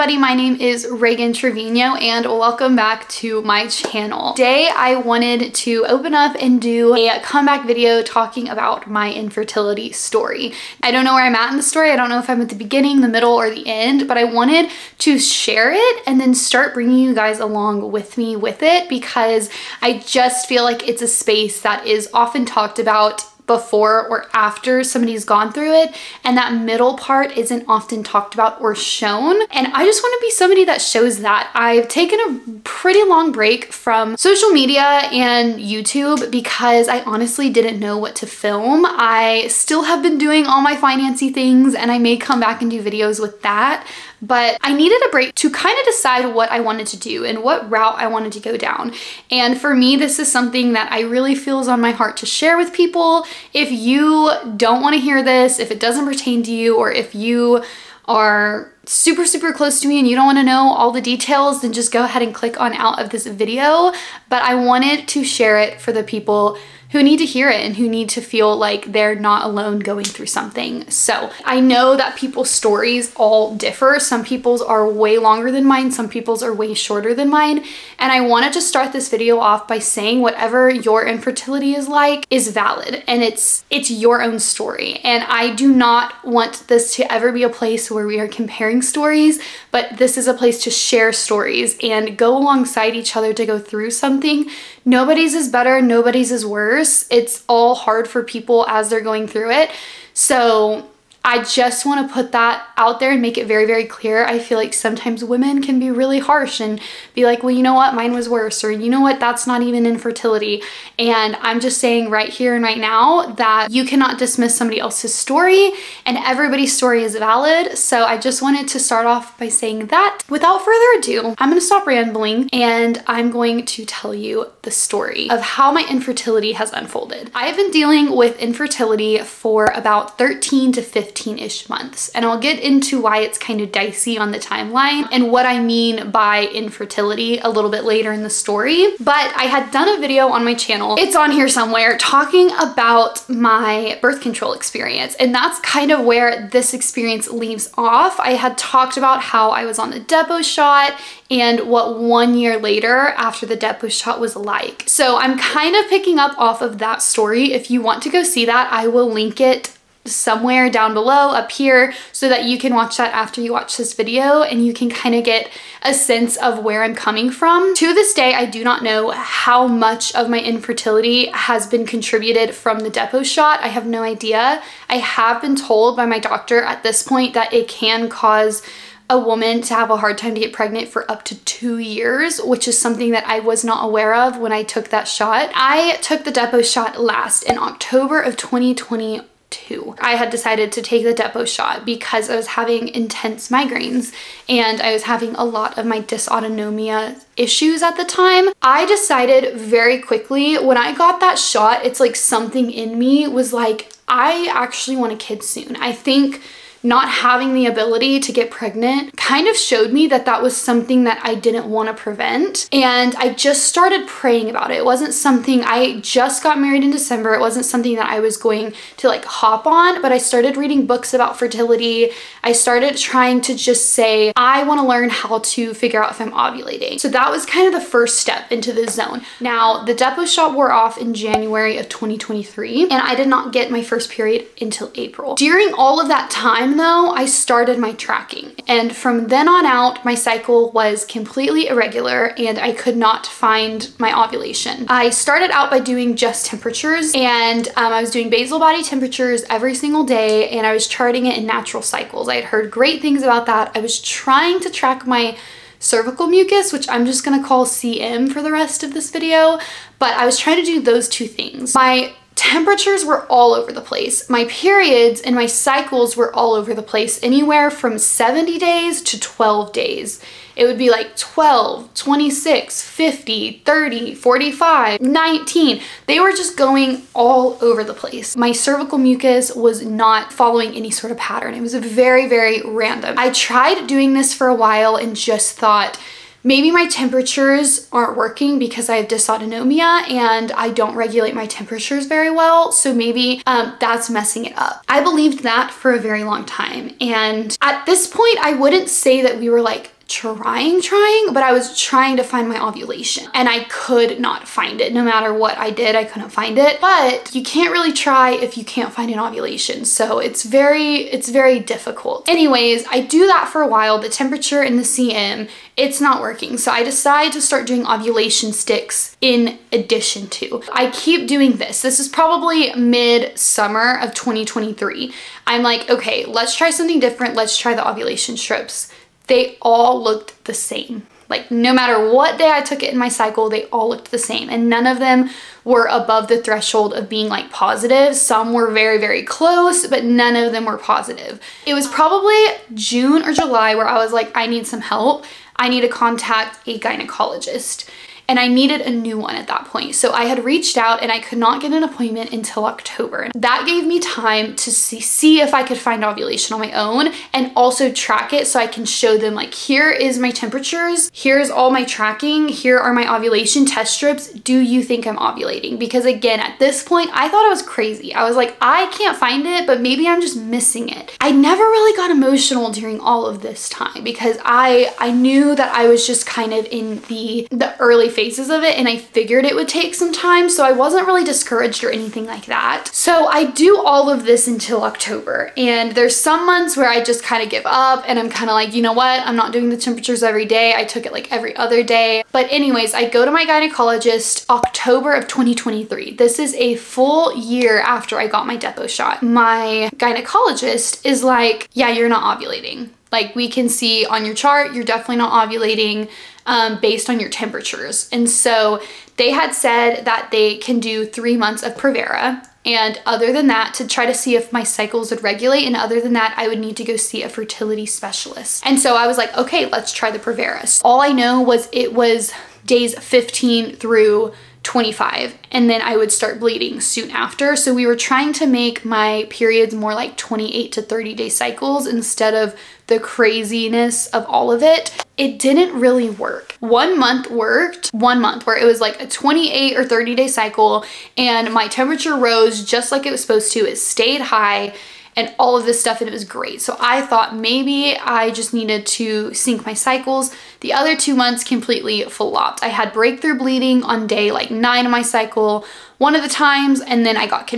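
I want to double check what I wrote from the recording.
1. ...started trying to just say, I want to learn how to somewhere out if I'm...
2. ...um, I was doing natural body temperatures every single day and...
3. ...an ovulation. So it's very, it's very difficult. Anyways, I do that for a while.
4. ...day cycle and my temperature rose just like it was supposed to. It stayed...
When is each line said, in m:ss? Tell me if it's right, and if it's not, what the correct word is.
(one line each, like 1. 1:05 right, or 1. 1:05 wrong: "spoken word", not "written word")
1. 3:42 wrong: "figure", not "somewhere"
2. 4:07 wrong: "basal", not "natural"
3. 5:09 right
4. 7:20 right.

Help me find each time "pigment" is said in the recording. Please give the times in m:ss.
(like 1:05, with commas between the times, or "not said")
not said.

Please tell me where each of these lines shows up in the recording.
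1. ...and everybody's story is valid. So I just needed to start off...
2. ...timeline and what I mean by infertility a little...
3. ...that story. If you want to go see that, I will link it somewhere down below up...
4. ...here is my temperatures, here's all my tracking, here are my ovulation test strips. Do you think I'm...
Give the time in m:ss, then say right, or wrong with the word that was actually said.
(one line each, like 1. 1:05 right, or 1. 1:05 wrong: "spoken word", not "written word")
1. 1:56 wrong: "wanted", not "needed"
2. 2:14 right
3. 2:36 right
4. 5:59 right.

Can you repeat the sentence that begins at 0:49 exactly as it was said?
And for me, this is something that I really feels on my heart to share with people.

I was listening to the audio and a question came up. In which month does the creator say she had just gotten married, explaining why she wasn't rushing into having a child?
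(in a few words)
December.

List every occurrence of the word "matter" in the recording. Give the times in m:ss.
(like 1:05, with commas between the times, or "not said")
5:05, 5:31.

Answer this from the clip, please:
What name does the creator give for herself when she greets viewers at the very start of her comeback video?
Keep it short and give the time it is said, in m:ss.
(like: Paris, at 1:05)
Ragan Trevino, at 0:00.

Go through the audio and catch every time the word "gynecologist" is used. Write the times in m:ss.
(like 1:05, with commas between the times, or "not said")
5:46, 6:33, 6:39.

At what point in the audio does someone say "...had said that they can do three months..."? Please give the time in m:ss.
6:49.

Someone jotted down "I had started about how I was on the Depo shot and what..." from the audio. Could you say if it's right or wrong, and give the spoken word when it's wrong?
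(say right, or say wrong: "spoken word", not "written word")
wrong: "talked", not "started".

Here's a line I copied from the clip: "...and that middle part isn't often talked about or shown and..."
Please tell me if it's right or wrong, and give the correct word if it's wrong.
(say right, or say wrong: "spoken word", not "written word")
right.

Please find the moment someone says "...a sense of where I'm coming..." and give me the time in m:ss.
2:45.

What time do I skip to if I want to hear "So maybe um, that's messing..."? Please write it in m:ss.
4:52.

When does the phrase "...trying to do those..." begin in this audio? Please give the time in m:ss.
4:20.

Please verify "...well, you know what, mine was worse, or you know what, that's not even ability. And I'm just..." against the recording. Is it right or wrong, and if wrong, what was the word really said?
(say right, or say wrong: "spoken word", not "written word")
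wrong: "infertility", not "ability".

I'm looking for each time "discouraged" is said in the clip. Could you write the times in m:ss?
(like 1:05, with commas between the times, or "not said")
6:21.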